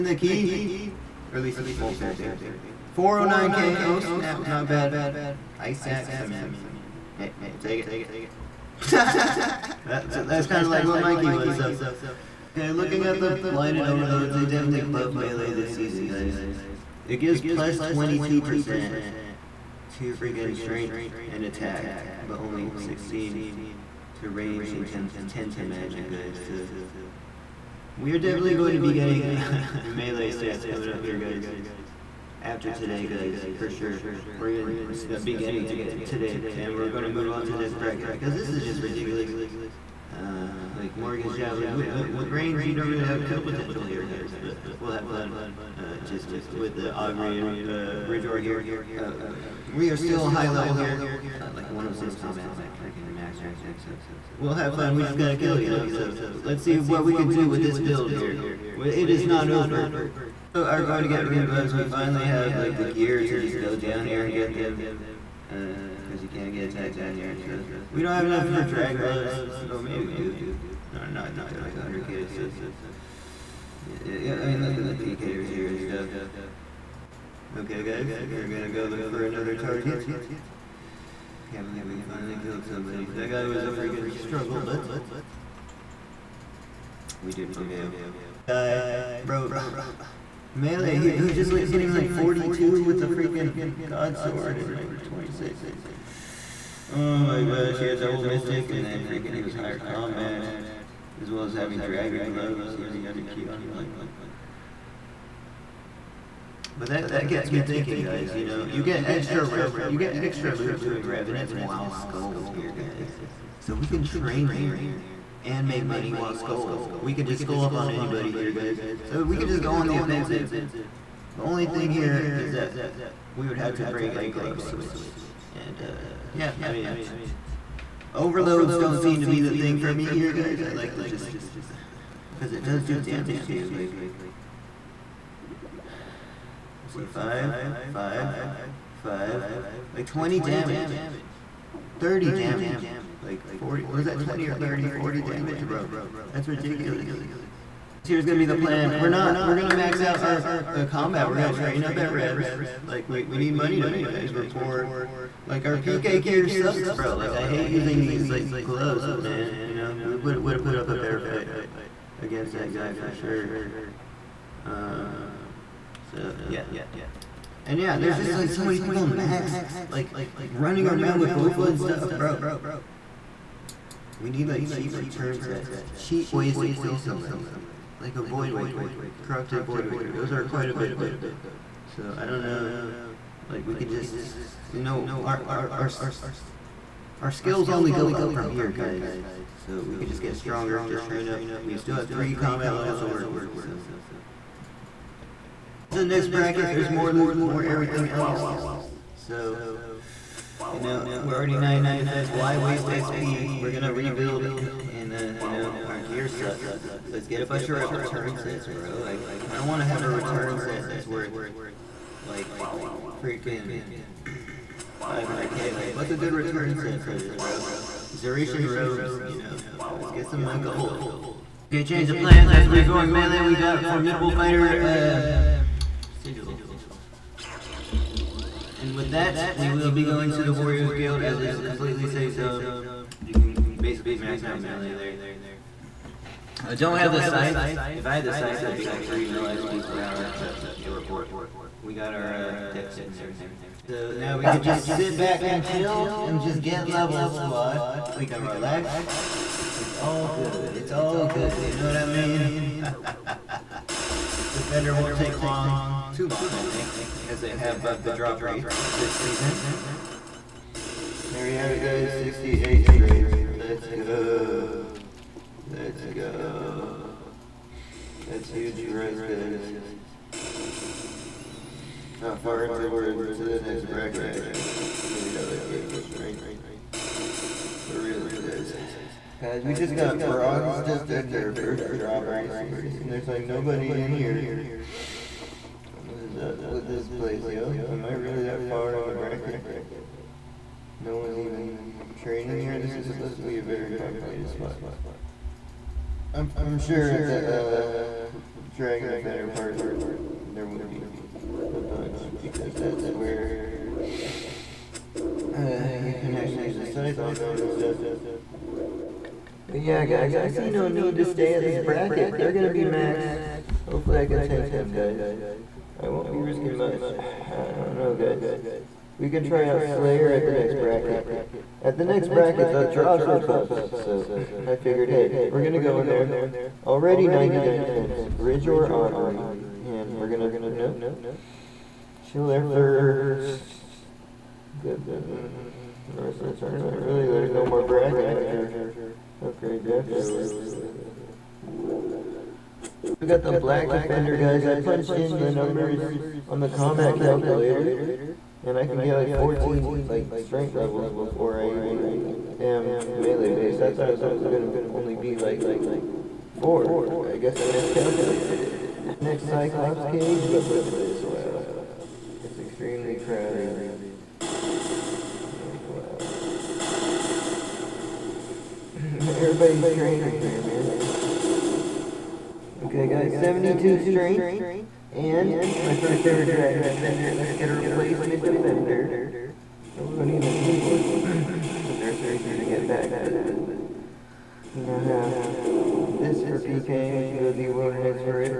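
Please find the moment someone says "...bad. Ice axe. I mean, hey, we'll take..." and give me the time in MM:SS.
00:04.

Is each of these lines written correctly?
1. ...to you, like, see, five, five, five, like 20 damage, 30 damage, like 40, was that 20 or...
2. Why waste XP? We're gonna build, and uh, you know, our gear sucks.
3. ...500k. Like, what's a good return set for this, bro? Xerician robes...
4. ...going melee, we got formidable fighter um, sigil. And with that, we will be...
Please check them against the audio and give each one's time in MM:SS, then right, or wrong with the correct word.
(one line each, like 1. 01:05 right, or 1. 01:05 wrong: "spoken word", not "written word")
1. 02:13 right
2. 03:22 wrong: "rebuild", not "build"
3. 03:34 right
4. 03:42 right.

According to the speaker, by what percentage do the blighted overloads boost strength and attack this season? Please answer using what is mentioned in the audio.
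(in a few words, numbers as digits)
22%.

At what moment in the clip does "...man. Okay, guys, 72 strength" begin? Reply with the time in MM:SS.
06:10.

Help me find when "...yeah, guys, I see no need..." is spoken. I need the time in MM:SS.
05:09.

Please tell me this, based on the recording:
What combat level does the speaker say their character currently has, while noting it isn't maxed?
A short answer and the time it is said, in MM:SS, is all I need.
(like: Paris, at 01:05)
106, at 00:51.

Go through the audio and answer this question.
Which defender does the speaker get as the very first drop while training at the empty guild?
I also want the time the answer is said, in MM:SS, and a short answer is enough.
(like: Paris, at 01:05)
Bronze defender, at 04:40.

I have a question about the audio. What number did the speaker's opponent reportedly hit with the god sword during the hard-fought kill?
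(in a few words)
42.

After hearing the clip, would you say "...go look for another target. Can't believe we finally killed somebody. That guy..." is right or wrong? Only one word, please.
right.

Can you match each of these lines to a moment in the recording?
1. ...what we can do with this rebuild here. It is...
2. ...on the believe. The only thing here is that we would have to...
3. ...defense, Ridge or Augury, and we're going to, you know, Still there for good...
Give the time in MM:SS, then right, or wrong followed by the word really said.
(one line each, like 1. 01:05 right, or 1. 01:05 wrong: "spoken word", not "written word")
1. 00:56 wrong: "build", not "rebuild"
2. 01:59 wrong: "offensive", not "believe"
3. 05:27 right.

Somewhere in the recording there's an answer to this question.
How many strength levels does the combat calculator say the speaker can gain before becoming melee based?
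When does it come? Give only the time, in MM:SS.
05:49.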